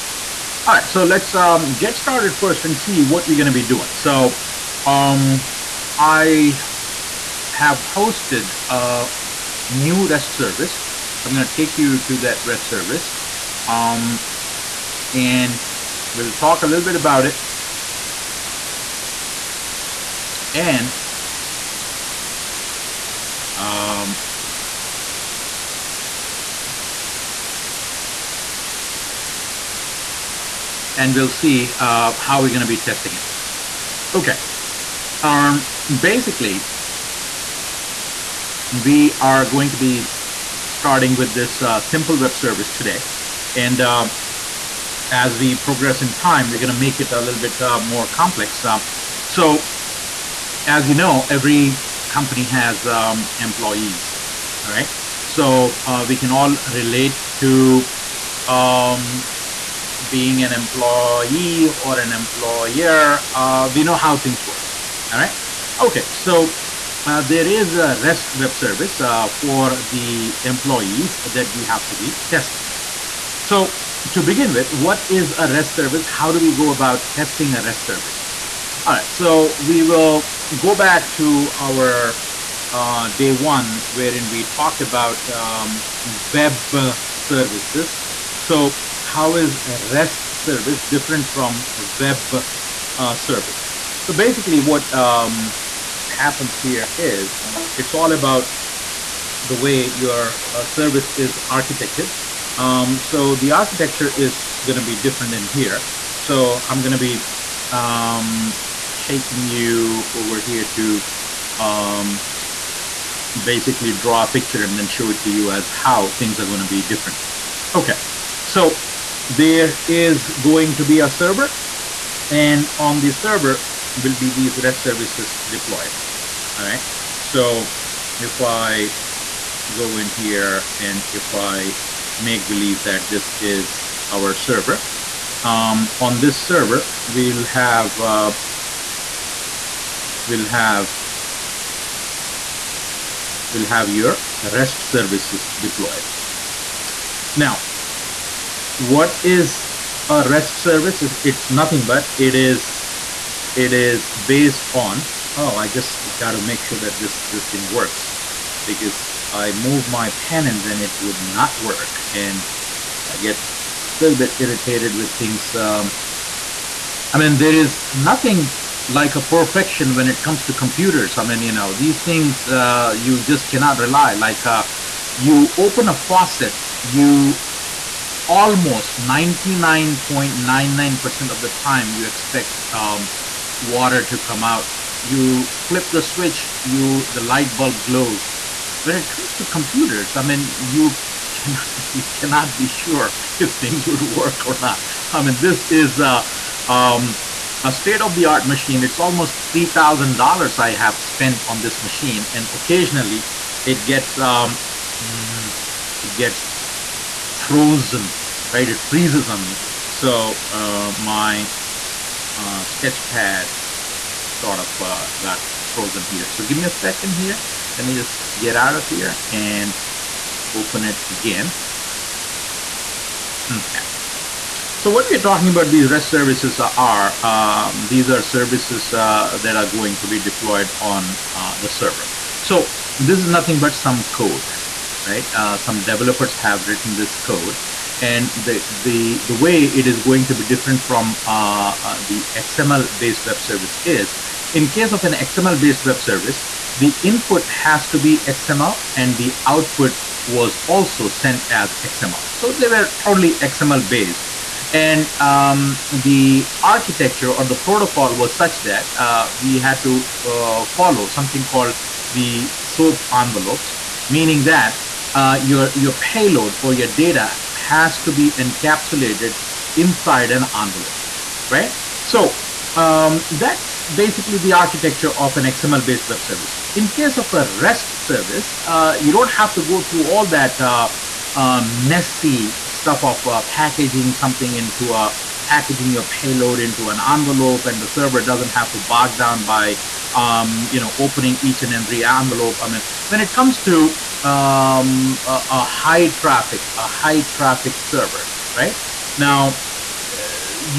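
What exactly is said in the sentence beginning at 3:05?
You flip the switch, you the light bulb glows.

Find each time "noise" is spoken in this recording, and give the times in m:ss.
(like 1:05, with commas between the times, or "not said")
not said.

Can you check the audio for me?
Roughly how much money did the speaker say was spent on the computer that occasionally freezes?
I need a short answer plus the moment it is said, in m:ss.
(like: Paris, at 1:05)
$3,000, at 3:19.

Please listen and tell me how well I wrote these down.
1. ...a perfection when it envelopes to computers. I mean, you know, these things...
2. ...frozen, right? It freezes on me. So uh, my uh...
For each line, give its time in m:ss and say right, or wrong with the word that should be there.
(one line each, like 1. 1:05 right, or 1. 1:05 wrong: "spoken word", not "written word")
1. 2:49 wrong: "comes", not "envelopes"
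2. 3:27 right.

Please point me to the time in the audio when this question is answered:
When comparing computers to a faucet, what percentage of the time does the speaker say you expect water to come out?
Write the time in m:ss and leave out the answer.
2:58.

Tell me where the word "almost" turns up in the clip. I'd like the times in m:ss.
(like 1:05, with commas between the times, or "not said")
2:58, 3:18.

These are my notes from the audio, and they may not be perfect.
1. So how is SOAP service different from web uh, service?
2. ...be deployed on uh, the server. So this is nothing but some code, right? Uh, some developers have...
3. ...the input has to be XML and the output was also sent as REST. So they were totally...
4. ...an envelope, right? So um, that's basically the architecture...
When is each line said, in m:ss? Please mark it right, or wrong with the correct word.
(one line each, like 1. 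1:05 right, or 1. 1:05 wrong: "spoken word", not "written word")
1. 1:28 wrong: "REST", not "SOAP"
2. 3:50 right
3. 4:06 wrong: "XML", not "REST"
4. 4:30 right.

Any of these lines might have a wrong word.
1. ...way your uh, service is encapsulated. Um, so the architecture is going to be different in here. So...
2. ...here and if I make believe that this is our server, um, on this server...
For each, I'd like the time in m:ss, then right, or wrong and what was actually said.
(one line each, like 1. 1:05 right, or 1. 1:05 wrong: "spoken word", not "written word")
1. 1:39 wrong: "architected", not "encapsulated"
2. 2:10 right.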